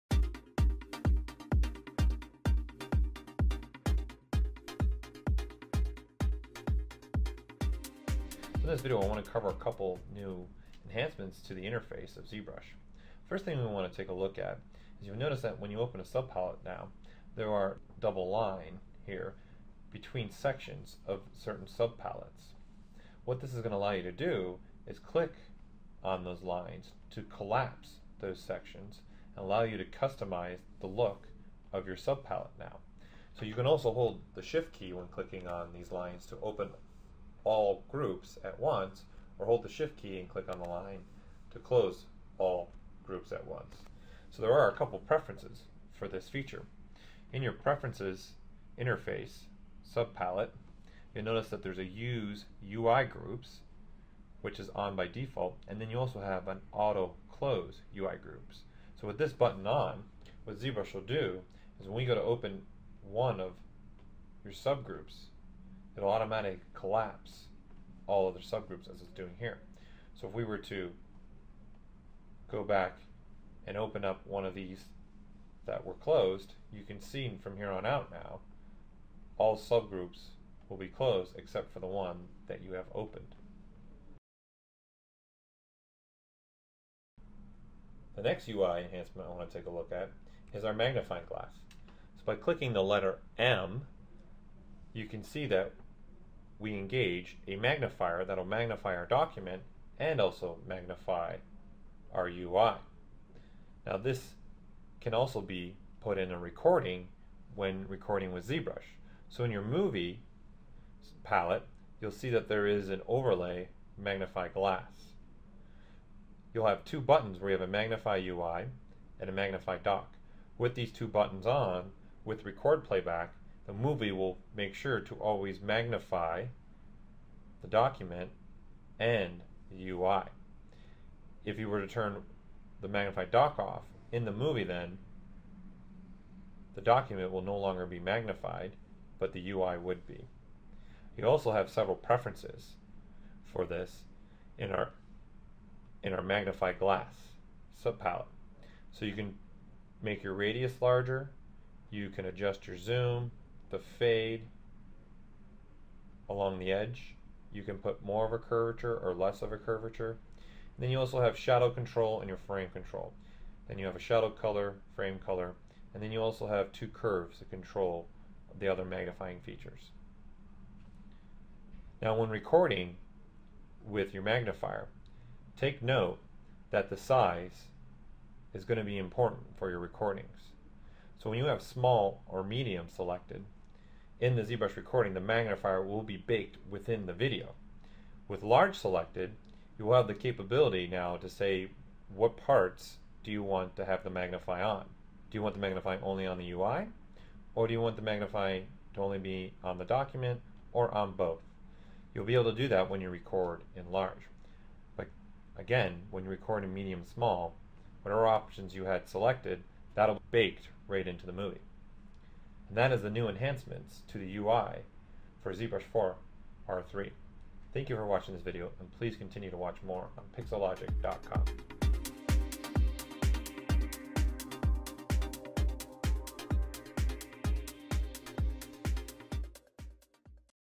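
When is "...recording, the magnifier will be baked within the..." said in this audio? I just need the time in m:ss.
3:04.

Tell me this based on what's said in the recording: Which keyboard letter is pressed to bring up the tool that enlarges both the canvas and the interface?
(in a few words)
M.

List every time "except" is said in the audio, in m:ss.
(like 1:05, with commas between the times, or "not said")
1:21.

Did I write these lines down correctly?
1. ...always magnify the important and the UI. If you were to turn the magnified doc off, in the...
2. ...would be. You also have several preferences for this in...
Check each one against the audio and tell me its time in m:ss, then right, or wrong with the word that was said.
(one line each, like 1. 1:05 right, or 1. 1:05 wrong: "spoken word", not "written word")
1. 2:05 wrong: "document", not "important"
2. 2:19 right.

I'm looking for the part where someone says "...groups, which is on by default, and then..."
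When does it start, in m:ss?
0:53.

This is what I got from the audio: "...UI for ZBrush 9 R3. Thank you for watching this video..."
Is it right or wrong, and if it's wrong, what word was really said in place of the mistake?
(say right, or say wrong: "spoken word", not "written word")
wrong: "4", not "9".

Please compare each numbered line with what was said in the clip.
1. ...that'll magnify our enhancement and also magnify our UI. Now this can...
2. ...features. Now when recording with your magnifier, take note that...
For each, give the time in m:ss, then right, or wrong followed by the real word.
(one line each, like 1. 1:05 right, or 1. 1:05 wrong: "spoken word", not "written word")
1. 1:38 wrong: "document", not "enhancement"
2. 2:49 right.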